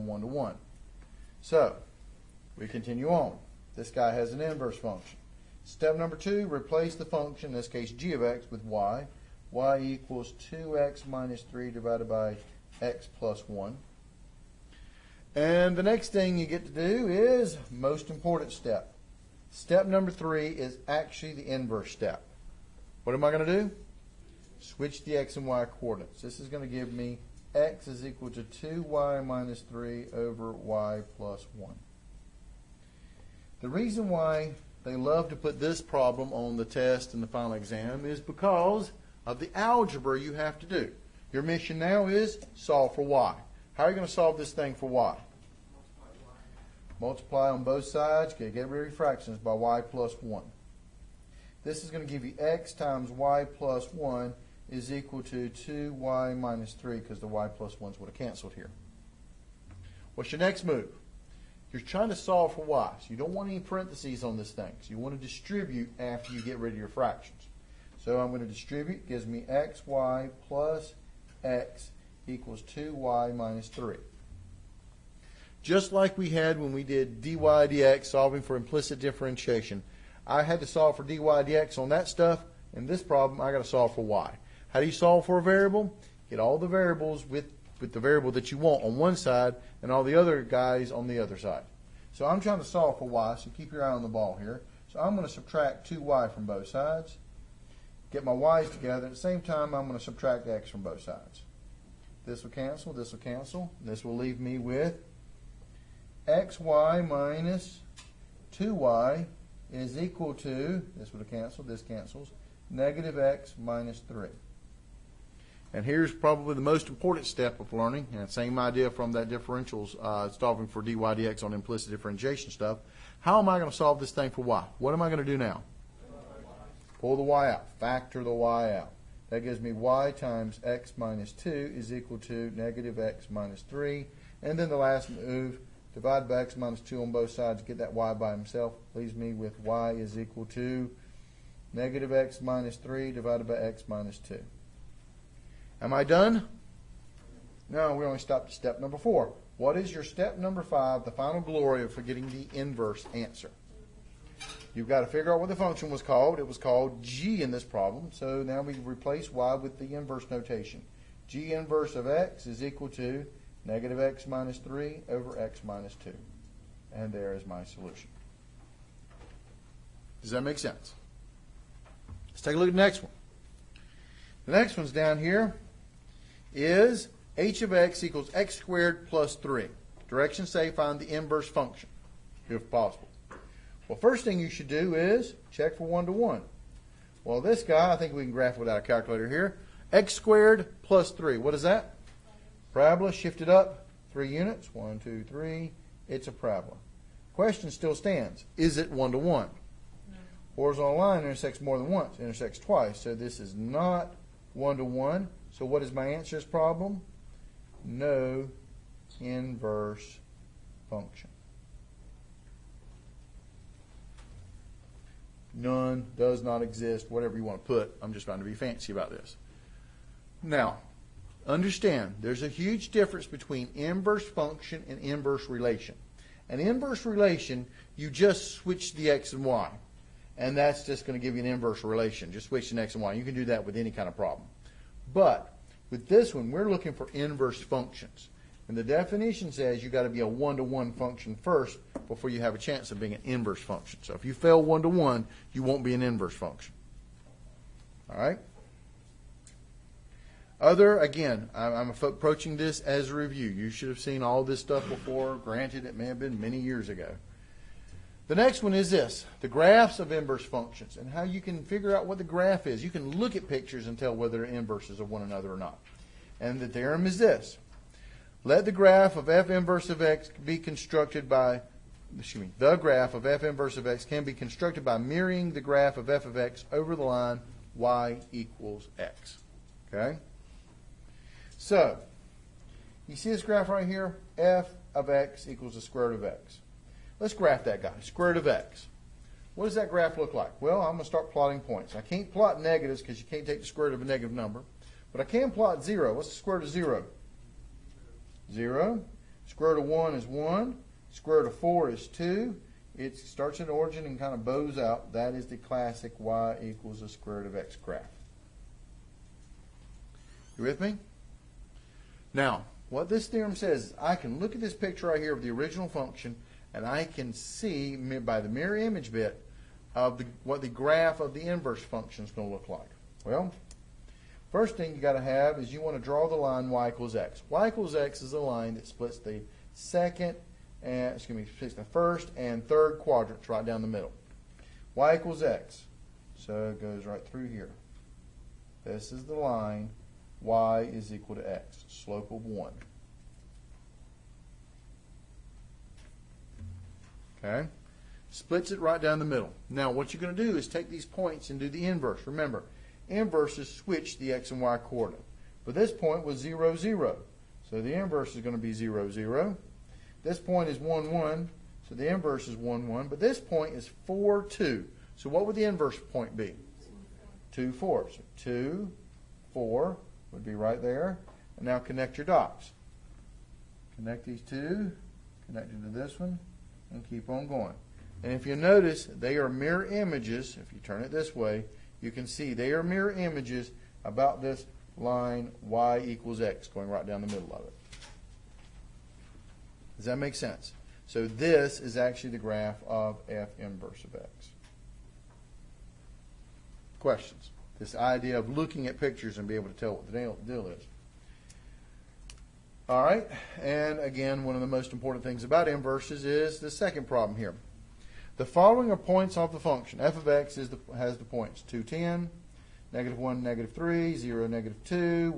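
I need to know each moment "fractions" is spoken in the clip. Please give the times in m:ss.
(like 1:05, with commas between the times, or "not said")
0:48, 1:06.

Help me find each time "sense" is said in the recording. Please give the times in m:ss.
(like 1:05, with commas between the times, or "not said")
2:50, 6:30.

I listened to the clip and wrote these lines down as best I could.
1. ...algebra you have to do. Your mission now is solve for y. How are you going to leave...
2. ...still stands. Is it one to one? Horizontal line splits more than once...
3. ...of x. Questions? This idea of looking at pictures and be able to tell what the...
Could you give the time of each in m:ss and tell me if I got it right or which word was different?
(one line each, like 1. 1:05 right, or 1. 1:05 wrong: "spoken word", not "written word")
1. 0:39 wrong: "solve", not "leave"
2. 3:17 wrong: "intersects", not "splits"
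3. 6:34 right.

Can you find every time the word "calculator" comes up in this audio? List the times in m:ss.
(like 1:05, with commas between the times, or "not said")
3:08.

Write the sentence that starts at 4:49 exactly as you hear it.
What does that graph look like?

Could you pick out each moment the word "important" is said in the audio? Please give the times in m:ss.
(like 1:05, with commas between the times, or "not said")
0:18, 1:56, 6:44.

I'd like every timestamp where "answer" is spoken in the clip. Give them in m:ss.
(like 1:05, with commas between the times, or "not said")
2:33, 3:26.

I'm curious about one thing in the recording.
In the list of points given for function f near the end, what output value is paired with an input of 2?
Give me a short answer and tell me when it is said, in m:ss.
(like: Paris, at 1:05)
10, at 6:51.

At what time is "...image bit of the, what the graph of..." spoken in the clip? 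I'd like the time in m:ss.
5:18.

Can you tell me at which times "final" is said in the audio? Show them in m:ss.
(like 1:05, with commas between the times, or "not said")
0:37, 2:31.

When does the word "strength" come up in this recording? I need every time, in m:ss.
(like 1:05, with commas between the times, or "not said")
not said.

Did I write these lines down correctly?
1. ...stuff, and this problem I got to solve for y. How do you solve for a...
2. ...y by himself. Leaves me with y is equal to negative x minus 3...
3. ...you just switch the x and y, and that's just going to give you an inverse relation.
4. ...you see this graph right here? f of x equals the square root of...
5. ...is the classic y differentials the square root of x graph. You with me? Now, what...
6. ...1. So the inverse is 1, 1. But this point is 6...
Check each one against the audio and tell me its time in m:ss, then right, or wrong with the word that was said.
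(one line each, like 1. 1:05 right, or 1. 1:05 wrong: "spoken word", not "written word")
1. 1:22 right
2. 2:17 right
3. 3:47 right
4. 4:43 right
5. 5:05 wrong: "equals", not "differentials"
6. 6:01 wrong: "4", not "6".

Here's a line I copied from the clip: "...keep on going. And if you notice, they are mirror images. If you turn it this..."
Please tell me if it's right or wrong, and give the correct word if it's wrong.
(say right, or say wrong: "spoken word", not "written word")
right.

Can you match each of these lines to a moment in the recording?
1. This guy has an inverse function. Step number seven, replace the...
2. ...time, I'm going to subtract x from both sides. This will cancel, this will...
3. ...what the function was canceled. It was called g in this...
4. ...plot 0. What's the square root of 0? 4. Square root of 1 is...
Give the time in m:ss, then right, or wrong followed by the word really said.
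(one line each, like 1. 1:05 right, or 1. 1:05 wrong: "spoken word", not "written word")
1. 0:03 wrong: "two", not "seven"
2. 1:39 right
3. 2:35 wrong: "called", not "canceled"
4. 4:55 wrong: "0", not "4".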